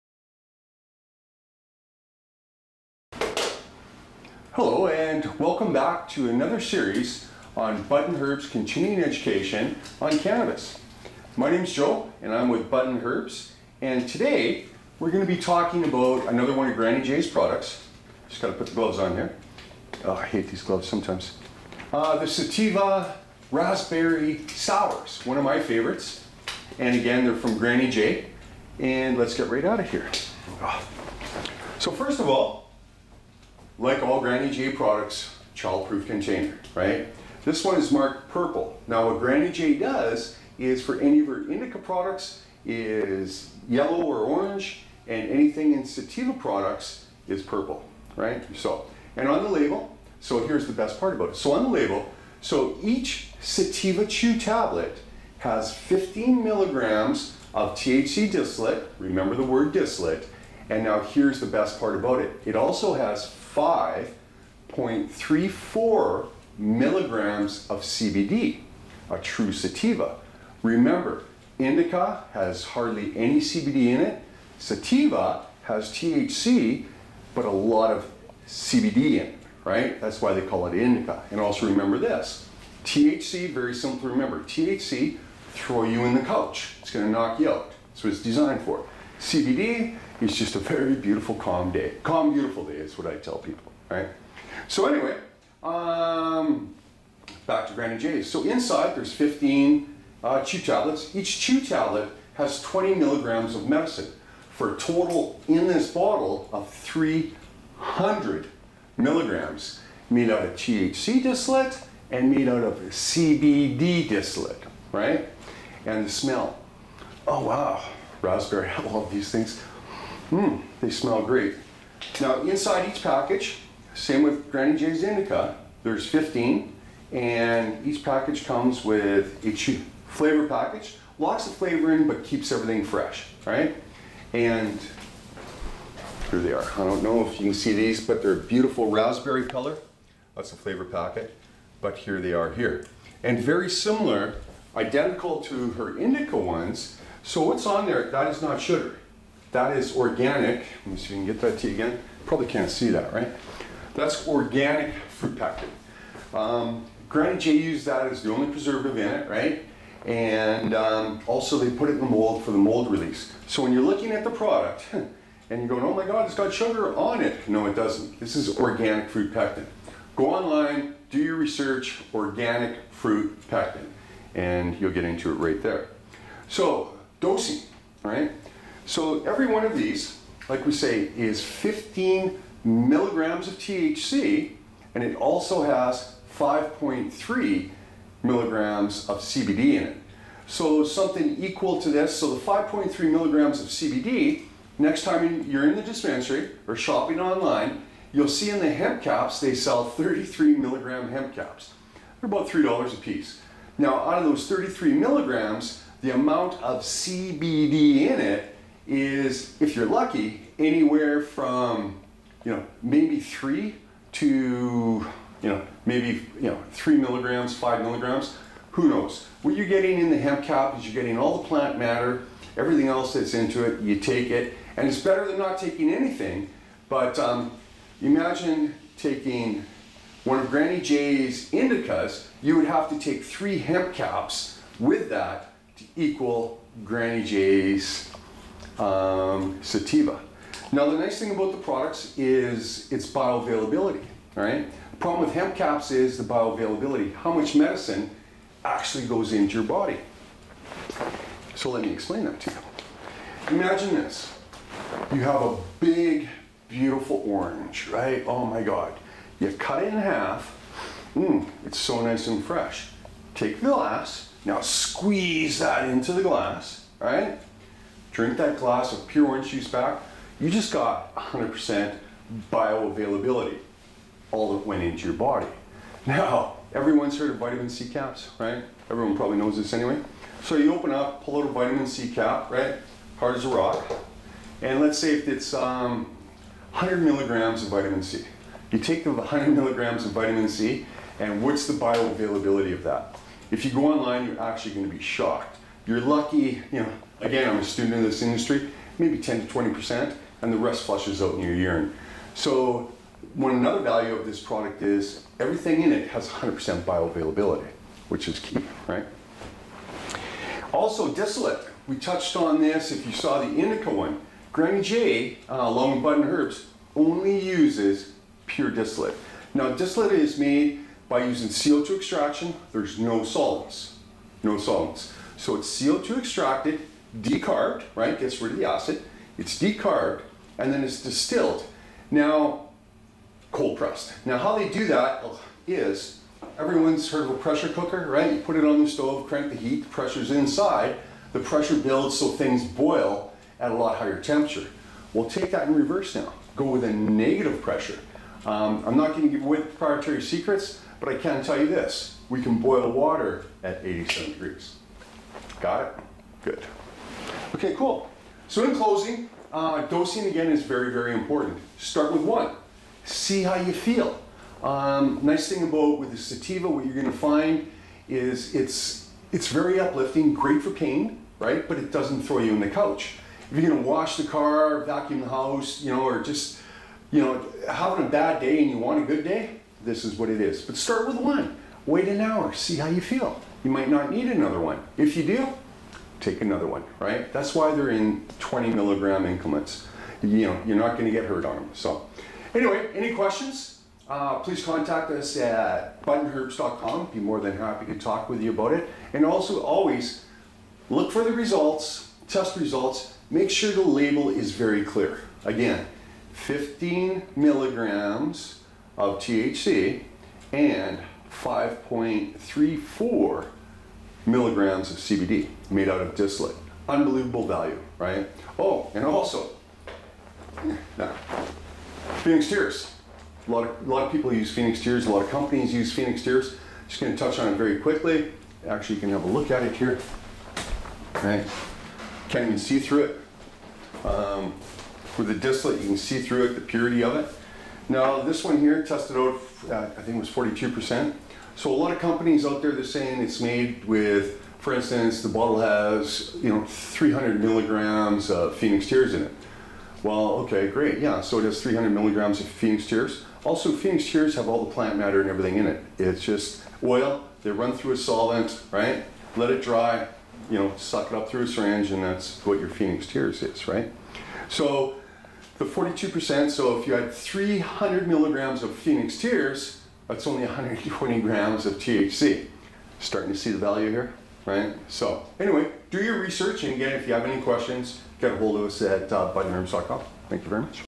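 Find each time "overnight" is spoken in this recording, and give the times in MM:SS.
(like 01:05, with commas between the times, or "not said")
not said.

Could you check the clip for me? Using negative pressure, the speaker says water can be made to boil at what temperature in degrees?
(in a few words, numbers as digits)
87 degrees.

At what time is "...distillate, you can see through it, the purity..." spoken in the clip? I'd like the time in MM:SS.
07:15.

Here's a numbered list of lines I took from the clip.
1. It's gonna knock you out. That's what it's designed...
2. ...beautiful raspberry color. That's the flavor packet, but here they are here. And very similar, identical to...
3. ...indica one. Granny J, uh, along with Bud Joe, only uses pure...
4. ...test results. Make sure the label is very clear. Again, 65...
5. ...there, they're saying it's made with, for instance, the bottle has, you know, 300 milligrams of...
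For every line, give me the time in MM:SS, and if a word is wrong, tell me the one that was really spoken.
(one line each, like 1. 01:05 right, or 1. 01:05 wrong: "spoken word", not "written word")
1. 01:26 right
2. 02:18 right
3. 05:13 wrong: "Herbs", not "Joe"
4. 06:42 wrong: "15", not "65"
5. 07:22 right.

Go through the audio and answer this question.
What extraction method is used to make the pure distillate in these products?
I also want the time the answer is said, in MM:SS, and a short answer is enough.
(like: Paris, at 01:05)
CO2 extraction, at 05:21.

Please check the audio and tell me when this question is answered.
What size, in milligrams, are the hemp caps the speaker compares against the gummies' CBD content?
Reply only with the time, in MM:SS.
03:19.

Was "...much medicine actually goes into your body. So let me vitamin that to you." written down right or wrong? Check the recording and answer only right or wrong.
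wrong.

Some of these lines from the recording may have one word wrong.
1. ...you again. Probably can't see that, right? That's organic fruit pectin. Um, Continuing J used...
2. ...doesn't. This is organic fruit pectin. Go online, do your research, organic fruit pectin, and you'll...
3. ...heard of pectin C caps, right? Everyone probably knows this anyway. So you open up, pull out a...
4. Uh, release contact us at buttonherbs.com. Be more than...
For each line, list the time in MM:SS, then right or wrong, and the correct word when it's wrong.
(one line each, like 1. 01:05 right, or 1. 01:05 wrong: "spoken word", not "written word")
1. 02:31 wrong: "Granny", not "Continuing"
2. 02:47 right
3. 04:37 wrong: "vitamin", not "pectin"
4. 06:34 wrong: "please", not "release".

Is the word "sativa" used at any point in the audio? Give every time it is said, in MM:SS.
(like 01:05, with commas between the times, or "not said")
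00:22, 00:45, 00:53, 01:09, 01:14, 03:59, 06:06.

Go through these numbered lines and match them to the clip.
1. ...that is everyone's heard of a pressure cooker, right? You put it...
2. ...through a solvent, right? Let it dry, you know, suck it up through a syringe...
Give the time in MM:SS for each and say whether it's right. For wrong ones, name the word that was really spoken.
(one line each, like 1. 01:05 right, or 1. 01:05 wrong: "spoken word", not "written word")
1. 05:34 right
2. 07:37 right.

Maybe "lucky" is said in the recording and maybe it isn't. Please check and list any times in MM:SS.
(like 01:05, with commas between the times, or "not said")
03:29, 04:56.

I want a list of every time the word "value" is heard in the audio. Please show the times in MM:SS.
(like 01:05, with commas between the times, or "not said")
05:03, 06:57, 07:53.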